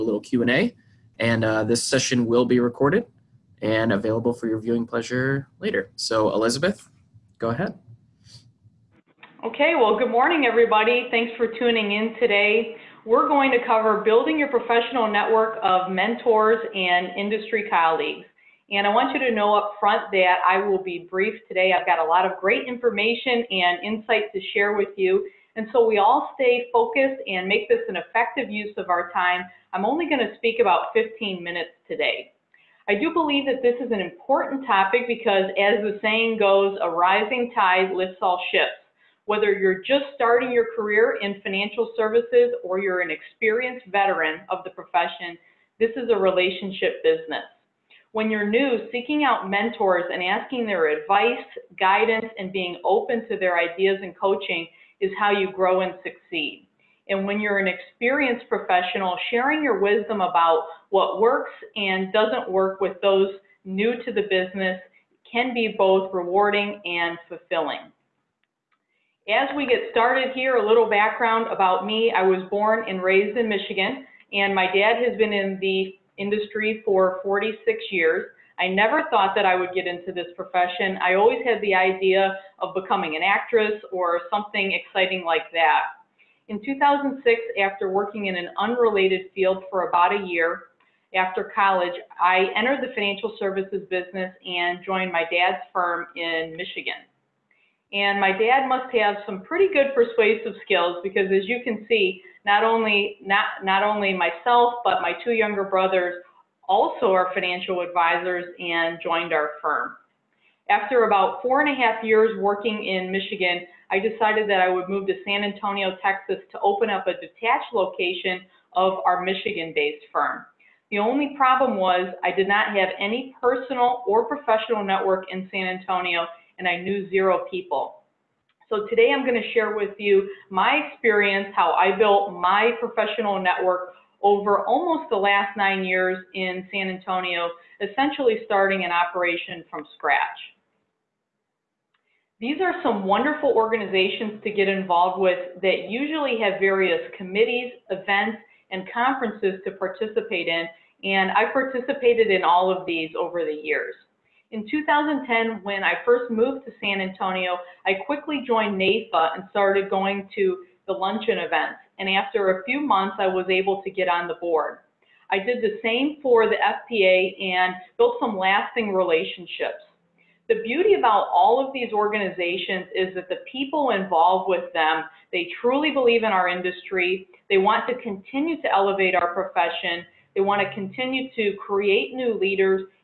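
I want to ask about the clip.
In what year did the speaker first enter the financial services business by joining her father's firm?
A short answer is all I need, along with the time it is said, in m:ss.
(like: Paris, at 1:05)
2006, at 1:26.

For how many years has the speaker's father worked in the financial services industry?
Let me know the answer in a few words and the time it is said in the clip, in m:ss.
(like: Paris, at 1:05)
46, at 1:17.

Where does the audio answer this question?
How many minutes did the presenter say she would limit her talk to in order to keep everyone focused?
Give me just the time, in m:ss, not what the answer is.
0:30.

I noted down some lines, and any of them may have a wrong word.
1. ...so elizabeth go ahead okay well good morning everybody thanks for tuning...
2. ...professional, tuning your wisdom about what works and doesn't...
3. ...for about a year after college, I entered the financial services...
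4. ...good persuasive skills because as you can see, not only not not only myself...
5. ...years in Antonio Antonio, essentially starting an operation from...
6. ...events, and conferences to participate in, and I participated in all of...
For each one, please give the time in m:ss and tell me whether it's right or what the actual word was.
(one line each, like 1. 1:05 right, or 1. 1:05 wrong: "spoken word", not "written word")
1. 0:05 right
2. 0:58 wrong: "sharing", not "tuning"
3. 1:29 right
4. 1:39 right
5. 2:15 wrong: "San", not "Antonio"
6. 2:27 right.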